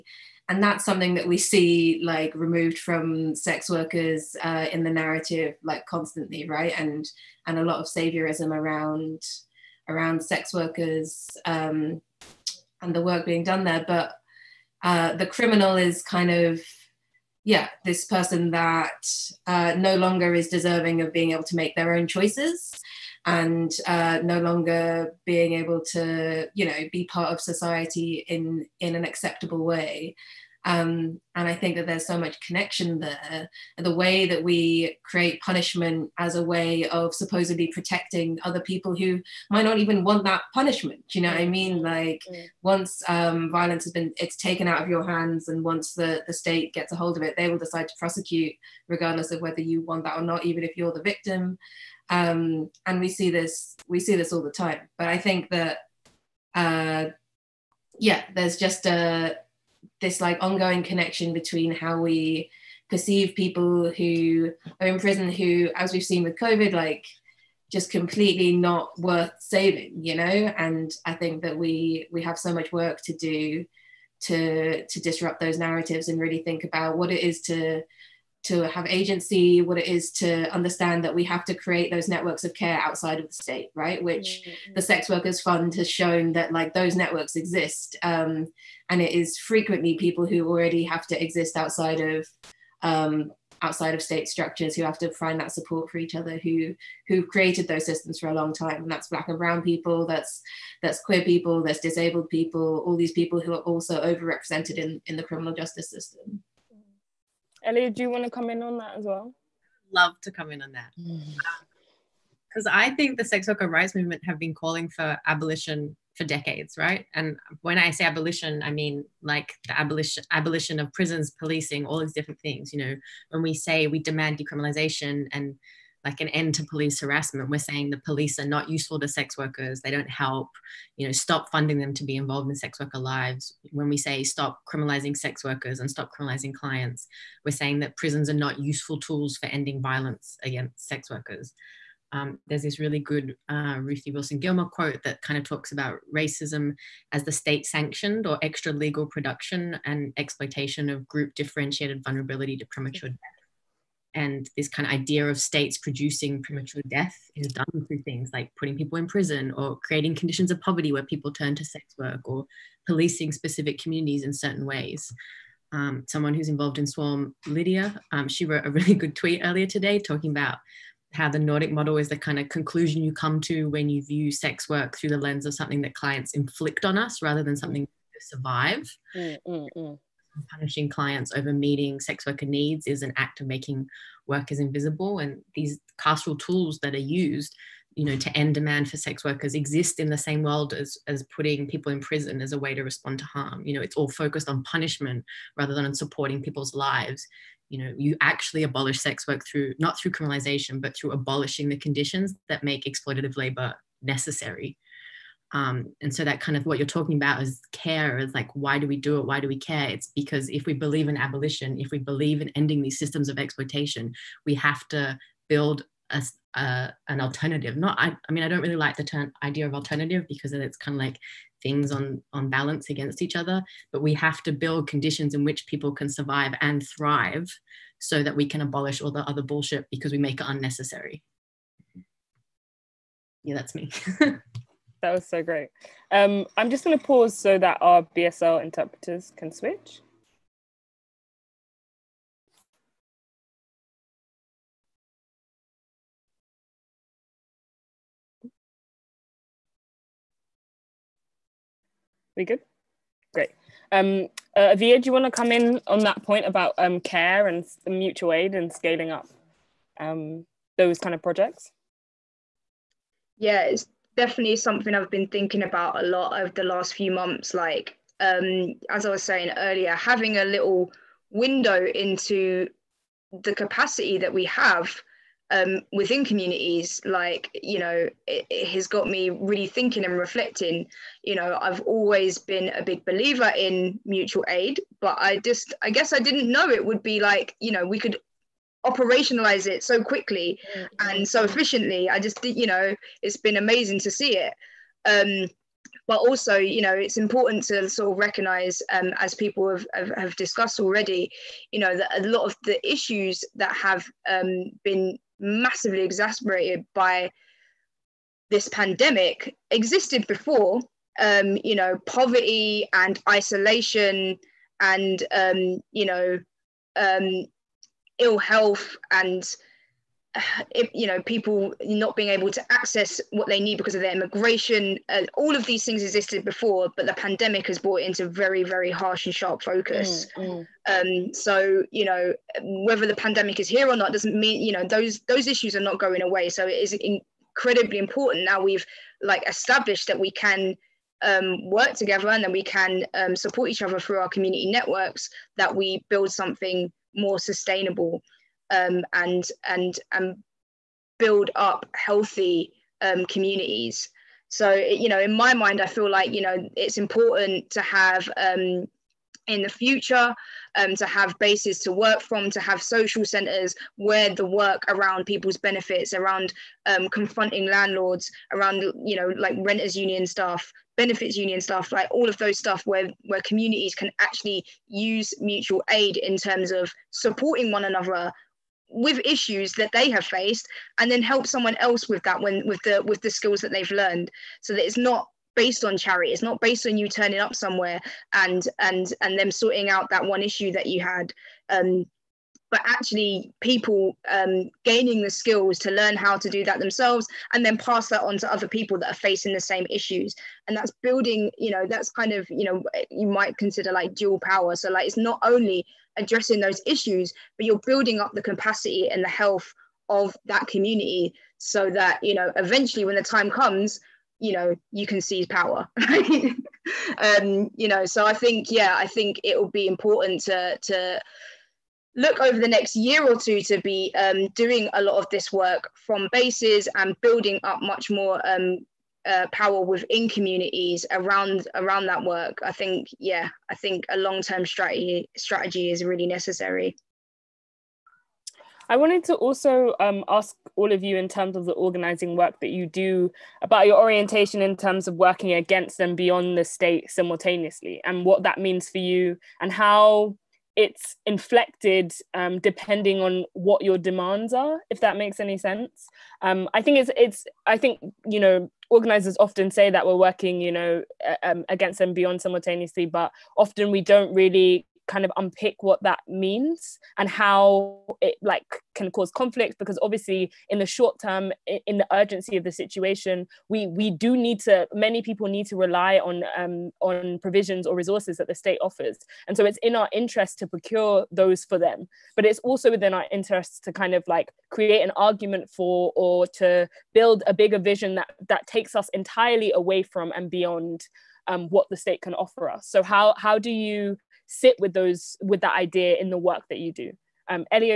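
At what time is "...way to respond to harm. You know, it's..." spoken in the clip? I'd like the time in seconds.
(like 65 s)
192 s.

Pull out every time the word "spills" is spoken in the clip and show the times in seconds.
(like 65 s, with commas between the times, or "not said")
not said.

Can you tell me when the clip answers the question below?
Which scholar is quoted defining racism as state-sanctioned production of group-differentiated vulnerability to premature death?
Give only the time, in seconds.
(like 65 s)
143 s.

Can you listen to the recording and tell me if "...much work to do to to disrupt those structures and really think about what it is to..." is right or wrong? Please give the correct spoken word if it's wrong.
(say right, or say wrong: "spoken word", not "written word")
wrong: "narratives", not "structures".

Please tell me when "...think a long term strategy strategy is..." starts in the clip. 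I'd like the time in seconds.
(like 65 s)
433 s.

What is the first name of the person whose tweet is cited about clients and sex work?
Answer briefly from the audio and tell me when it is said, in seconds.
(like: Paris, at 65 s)
Lydia, at 167 s.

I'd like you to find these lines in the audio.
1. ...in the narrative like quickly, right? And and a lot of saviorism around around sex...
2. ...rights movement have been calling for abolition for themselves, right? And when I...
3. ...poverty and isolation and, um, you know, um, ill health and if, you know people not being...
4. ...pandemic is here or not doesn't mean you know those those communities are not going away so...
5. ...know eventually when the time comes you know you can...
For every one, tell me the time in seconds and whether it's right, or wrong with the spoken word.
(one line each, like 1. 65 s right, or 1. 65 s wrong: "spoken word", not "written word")
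1. 4 s wrong: "constantly", not "quickly"
2. 113 s wrong: "decades", not "themselves"
3. 312 s right
4. 333 s wrong: "issues", not "communities"
5. 412 s right.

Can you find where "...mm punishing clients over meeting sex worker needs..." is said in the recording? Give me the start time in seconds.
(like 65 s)
179 s.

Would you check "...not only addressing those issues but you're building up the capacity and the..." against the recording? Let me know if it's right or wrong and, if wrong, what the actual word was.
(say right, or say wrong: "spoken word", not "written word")
right.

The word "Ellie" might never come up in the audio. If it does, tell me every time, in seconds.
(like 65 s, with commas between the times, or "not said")
107 s.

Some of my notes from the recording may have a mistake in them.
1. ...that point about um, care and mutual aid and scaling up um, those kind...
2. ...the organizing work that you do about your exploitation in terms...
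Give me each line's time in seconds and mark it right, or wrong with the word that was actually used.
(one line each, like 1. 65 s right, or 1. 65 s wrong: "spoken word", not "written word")
1. 255 s right
2. 441 s wrong: "orientation", not "exploitation".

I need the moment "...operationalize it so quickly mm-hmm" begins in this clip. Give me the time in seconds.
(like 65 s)
288 s.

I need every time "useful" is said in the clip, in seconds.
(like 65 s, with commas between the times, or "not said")
128 s, 138 s.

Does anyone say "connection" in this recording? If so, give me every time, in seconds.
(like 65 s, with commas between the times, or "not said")
32 s, 60 s.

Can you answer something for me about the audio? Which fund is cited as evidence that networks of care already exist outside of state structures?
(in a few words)
Sex Workers Fund.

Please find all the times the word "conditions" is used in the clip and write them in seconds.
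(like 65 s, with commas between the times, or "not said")
160 s, 201 s, 224 s.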